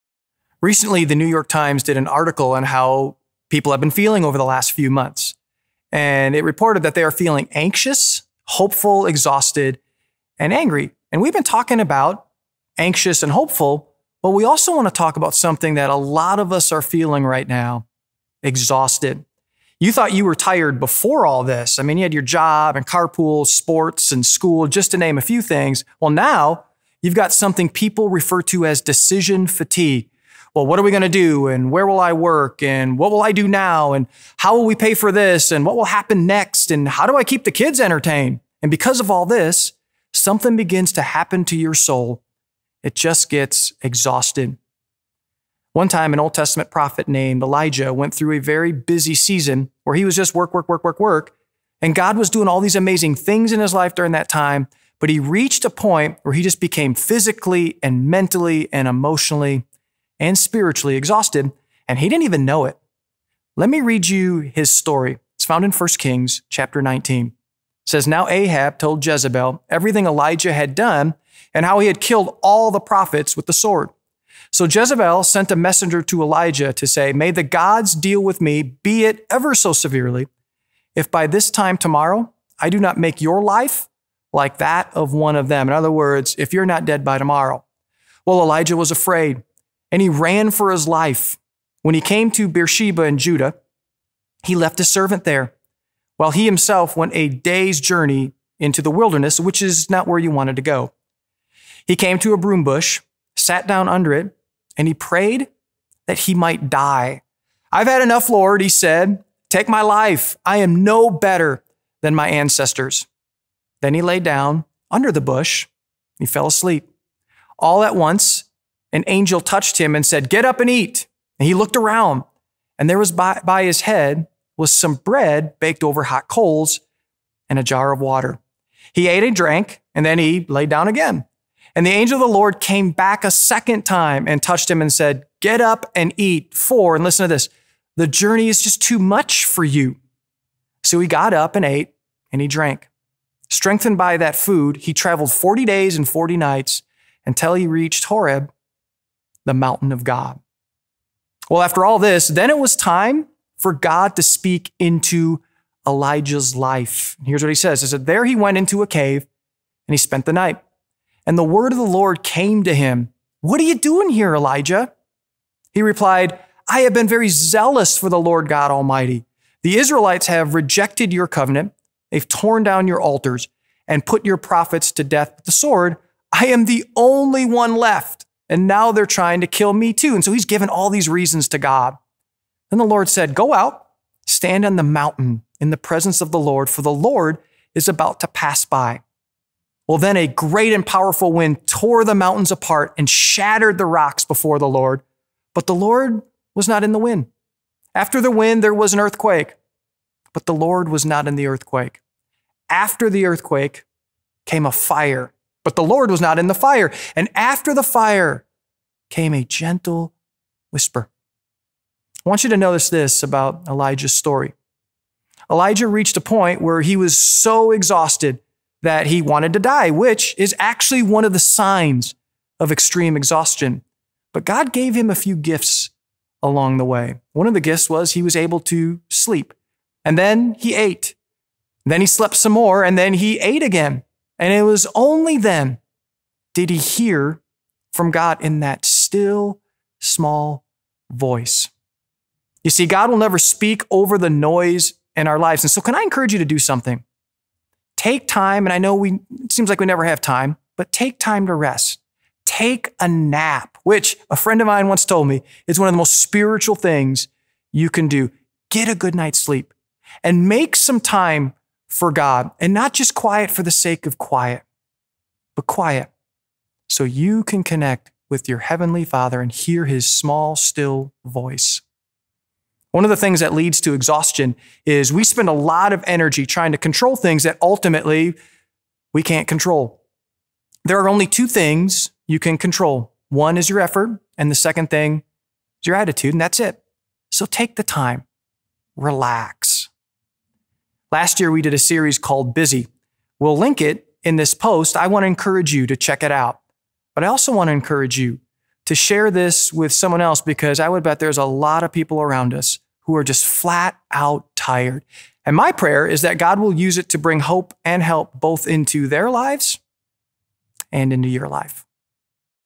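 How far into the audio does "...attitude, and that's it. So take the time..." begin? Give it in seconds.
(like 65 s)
285 s.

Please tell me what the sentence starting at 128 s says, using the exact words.
He ate and drank, and then he lay down again.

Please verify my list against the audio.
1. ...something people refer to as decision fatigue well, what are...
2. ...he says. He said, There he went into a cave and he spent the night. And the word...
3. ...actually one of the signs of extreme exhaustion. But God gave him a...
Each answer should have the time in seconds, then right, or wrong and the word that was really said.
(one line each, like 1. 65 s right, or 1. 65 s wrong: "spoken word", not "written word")
1. 27 s right
2. 157 s right
3. 220 s right.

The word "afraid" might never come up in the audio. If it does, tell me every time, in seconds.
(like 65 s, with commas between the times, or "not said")
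88 s.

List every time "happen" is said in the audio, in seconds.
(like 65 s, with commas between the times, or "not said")
35 s, 41 s.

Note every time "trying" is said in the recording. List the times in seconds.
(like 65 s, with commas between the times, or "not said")
179 s, 276 s.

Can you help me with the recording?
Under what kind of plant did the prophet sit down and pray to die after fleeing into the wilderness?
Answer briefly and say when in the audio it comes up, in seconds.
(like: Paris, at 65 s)
broom bush, at 102 s.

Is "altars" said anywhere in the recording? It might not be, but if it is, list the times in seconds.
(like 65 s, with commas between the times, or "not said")
173 s.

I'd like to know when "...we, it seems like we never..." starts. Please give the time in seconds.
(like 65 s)
248 s.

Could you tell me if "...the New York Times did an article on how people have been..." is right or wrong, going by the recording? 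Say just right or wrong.
right.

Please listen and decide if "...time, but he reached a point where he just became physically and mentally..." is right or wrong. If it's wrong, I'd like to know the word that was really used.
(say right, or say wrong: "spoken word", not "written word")
right.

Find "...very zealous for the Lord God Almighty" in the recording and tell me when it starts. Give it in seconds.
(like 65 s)
167 s.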